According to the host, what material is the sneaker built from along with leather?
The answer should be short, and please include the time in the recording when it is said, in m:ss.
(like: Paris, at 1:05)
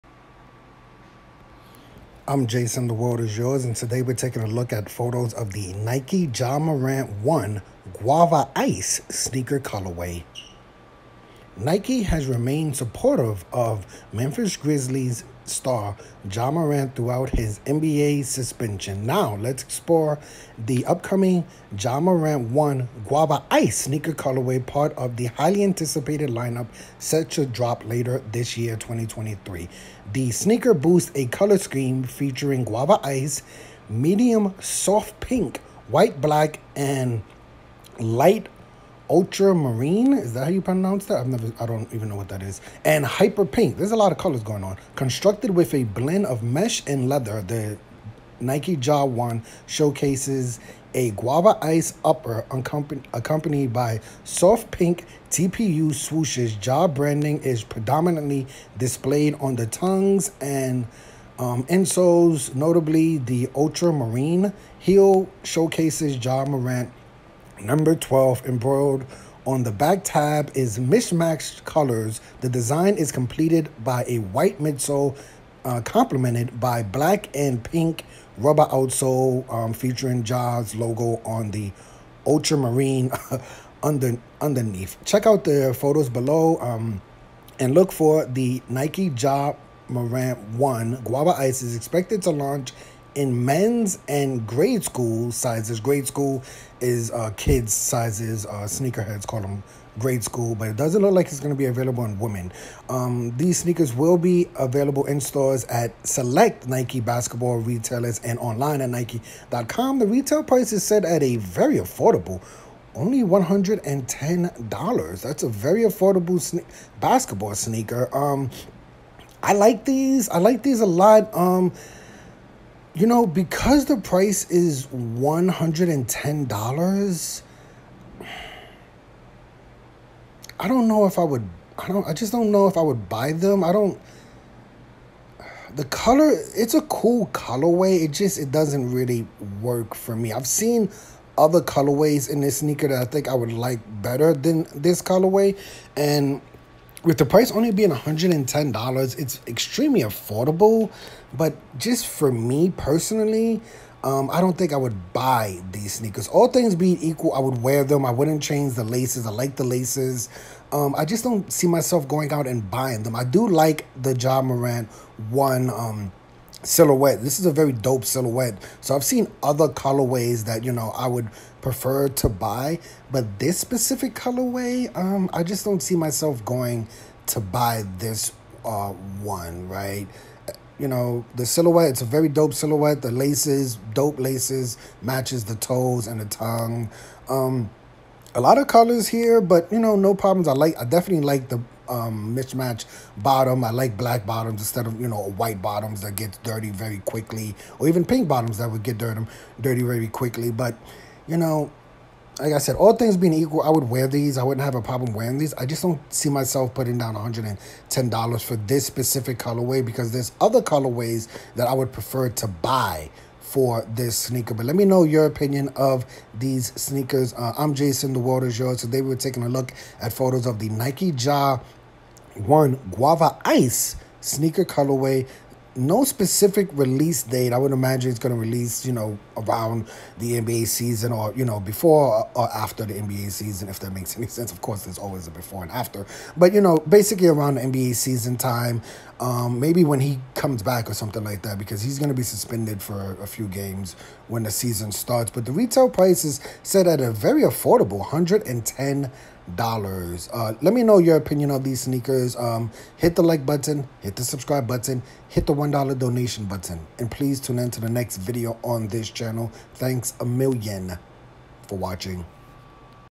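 mesh, at 0:46.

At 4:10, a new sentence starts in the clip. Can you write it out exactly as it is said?
Uh, let me know your opinion of these sneakers.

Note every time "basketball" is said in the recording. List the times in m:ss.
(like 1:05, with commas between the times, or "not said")
1:47, 1:56.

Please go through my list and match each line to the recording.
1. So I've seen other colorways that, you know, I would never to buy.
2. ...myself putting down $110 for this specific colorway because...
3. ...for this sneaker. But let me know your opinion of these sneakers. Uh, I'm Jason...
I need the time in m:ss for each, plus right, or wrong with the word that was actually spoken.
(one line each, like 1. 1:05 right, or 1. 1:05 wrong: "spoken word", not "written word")
1. 2:48 wrong: "prefer", not "never"
2. 3:26 right
3. 3:33 right.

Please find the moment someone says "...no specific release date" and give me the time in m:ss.
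3:45.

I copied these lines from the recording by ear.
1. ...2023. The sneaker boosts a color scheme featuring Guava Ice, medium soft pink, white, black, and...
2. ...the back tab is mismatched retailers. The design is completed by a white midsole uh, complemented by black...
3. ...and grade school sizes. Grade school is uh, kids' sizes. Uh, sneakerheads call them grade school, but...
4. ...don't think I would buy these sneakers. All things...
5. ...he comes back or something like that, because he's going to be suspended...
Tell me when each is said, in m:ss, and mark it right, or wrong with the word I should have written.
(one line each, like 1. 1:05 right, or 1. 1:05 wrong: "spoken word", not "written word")
1. 0:28 right
2. 1:09 wrong: "colors", not "retailers"
3. 1:34 right
4. 2:34 right
5. 4:00 right.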